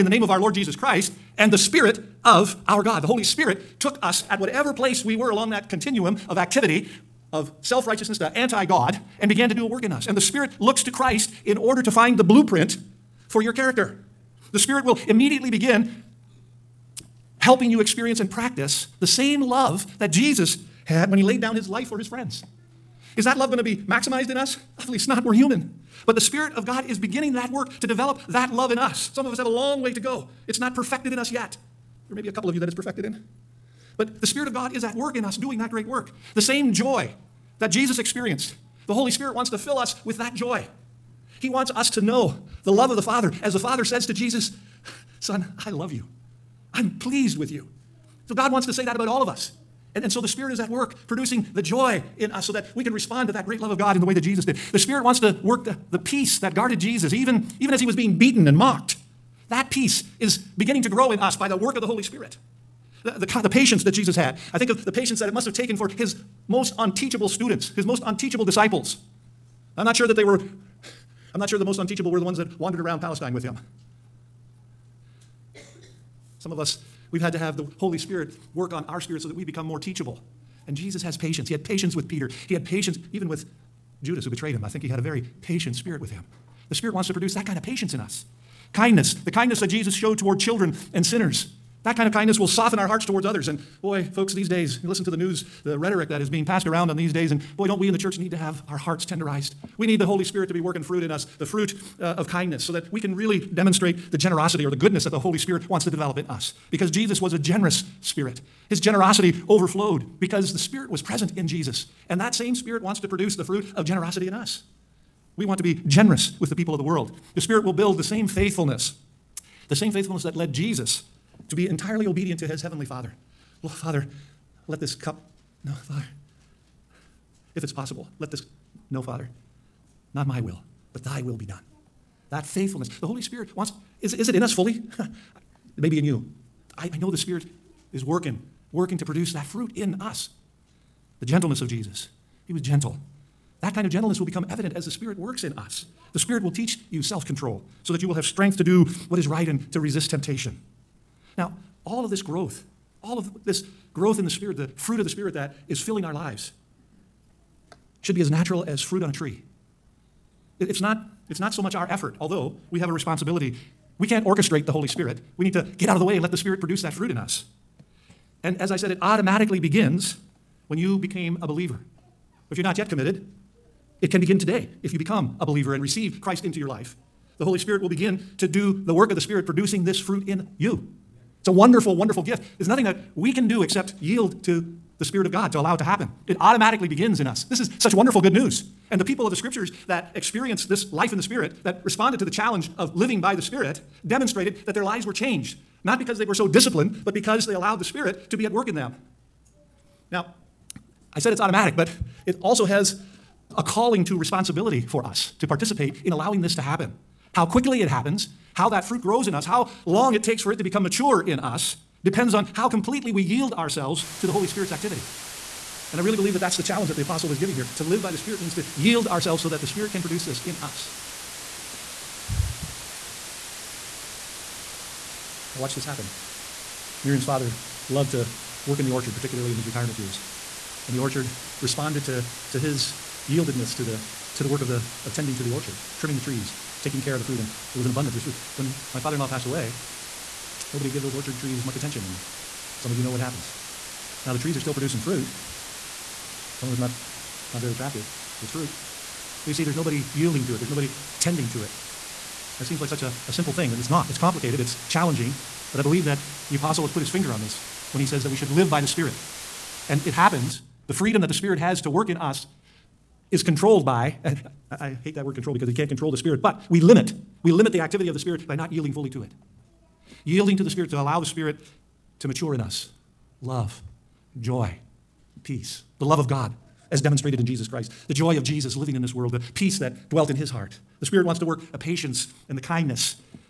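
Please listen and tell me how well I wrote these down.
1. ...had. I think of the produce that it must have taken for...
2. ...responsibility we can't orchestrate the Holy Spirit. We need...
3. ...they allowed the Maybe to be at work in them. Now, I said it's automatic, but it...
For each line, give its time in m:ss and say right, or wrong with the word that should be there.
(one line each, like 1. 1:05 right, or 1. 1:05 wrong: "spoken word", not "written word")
1. 1:04 wrong: "patience", not "produce"
2. 2:42 right
3. 3:17 wrong: "Spirit", not "Maybe".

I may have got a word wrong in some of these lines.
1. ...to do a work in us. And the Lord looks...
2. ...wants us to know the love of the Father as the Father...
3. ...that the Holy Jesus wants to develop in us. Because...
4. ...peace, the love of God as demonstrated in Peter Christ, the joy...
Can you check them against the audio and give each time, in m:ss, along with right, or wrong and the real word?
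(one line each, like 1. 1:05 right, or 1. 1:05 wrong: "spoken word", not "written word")
1. 0:09 wrong: "Spirit", not "Lord"
2. 0:41 right
3. 1:45 wrong: "Spirit", not "Jesus"
4. 4:35 wrong: "Jesus", not "Peter".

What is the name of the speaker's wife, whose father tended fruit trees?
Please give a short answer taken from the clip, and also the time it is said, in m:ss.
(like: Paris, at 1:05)
Miriam, at 3:47.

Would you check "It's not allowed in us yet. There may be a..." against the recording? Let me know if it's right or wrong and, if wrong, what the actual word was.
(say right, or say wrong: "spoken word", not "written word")
wrong: "perfected", not "allowed".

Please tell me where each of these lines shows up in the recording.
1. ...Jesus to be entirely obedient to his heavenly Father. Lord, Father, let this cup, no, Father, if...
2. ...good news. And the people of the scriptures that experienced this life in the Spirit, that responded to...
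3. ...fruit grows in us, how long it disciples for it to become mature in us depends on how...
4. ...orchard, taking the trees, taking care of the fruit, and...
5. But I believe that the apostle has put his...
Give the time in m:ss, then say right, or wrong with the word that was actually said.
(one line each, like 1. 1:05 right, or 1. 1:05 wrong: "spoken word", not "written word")
1. 2:00 right
2. 3:08 right
3. 3:28 wrong: "takes", not "disciples"
4. 3:55 wrong: "trimming", not "taking"
5. 4:15 right.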